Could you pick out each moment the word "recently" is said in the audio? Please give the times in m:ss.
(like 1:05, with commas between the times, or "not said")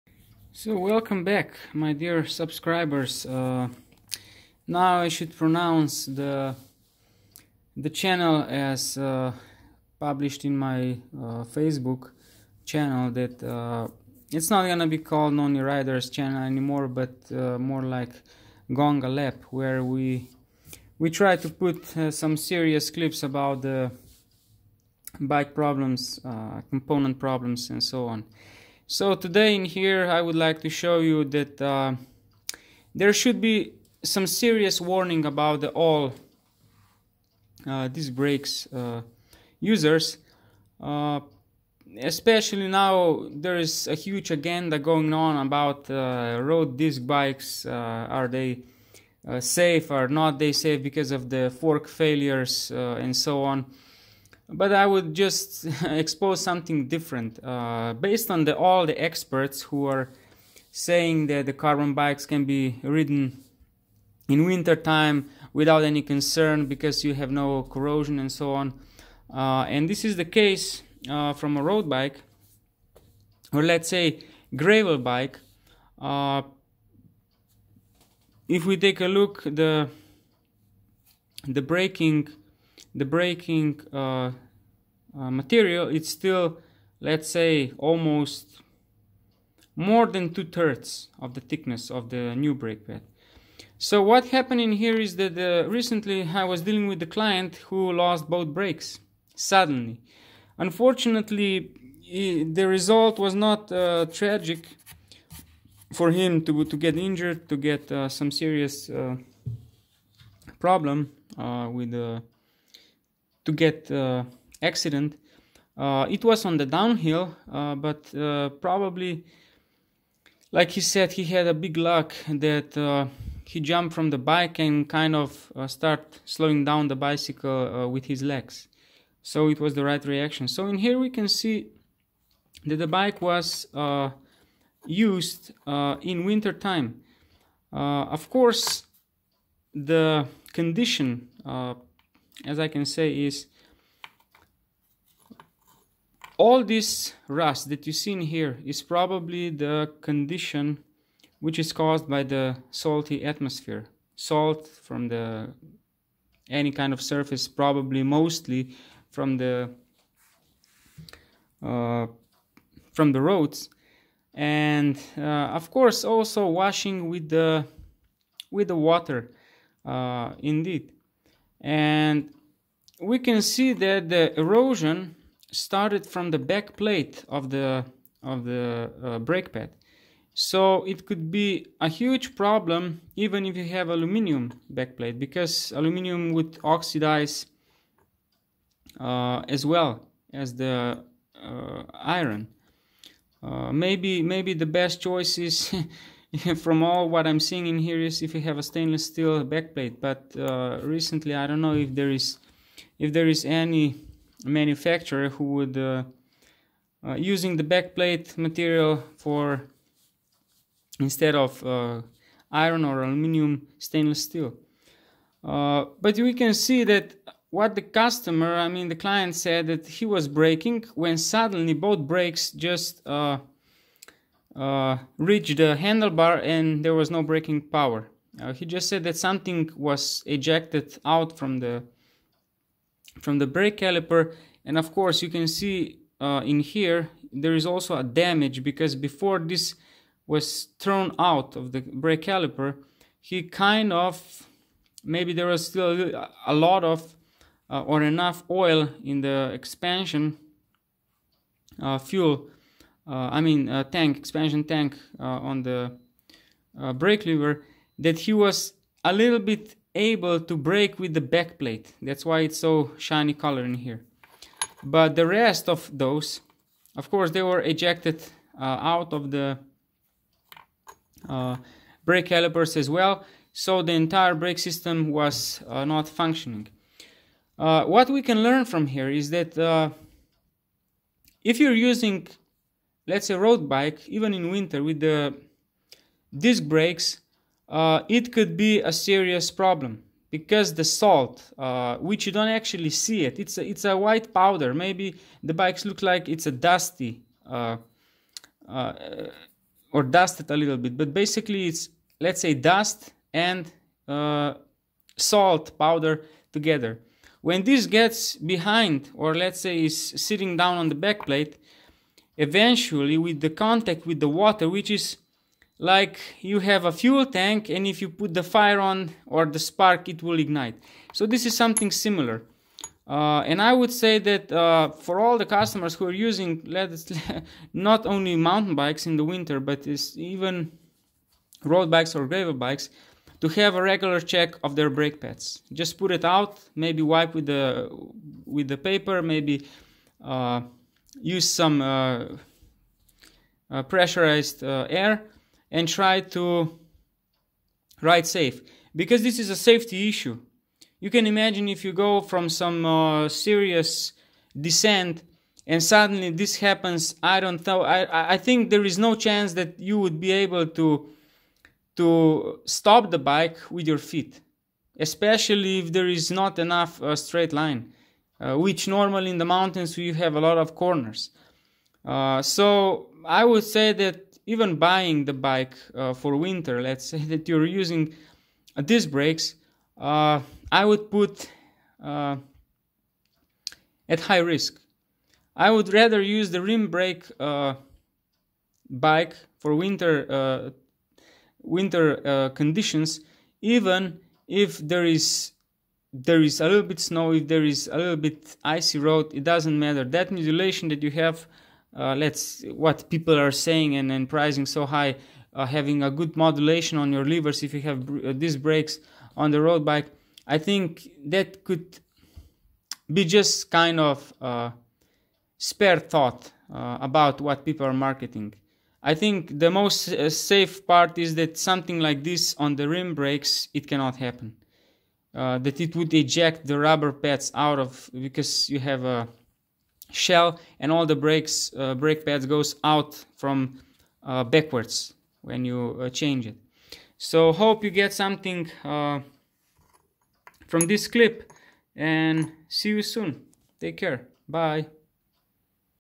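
1:35, 3:20.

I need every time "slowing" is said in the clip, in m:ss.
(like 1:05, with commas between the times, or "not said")
2:06.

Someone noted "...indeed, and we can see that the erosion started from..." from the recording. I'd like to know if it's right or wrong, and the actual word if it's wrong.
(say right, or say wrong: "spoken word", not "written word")
right.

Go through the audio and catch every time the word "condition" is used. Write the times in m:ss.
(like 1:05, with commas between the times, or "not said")
2:20, 2:30, 6:32.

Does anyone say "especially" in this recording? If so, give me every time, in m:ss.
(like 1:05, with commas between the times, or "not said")
0:42, 6:04.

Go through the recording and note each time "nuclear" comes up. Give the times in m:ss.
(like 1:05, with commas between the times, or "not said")
not said.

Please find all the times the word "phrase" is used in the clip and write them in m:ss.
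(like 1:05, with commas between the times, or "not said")
not said.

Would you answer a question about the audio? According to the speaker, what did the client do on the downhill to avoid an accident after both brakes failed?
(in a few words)
jumped from the bike.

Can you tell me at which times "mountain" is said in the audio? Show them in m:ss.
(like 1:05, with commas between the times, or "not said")
5:28, 6:09.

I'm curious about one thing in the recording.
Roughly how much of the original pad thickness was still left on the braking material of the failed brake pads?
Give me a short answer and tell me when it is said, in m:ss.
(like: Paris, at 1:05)
two-thirds, at 1:30.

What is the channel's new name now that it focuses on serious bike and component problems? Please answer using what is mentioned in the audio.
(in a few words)
Gonga Lab.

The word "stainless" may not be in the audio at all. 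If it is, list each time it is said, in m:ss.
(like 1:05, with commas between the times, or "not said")
3:18, 3:33.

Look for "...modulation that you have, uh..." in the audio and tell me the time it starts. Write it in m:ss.
6:40.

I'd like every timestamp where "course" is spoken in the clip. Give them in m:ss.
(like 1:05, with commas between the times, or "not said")
2:18, 2:45, 3:54, 4:27.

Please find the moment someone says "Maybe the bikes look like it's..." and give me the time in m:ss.
4:54.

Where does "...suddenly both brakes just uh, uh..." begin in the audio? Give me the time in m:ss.
3:41.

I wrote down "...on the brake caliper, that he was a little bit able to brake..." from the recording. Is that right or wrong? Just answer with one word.
wrong.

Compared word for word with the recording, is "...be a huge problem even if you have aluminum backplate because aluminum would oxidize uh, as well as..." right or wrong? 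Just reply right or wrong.
right.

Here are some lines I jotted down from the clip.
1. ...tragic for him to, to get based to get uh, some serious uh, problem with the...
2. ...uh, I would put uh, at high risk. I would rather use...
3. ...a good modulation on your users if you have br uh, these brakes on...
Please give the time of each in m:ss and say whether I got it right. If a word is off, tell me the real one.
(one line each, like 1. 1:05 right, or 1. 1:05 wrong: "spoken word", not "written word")
1. 1:44 wrong: "injured", not "based"
2. 6:19 right
3. 6:46 wrong: "levers", not "users".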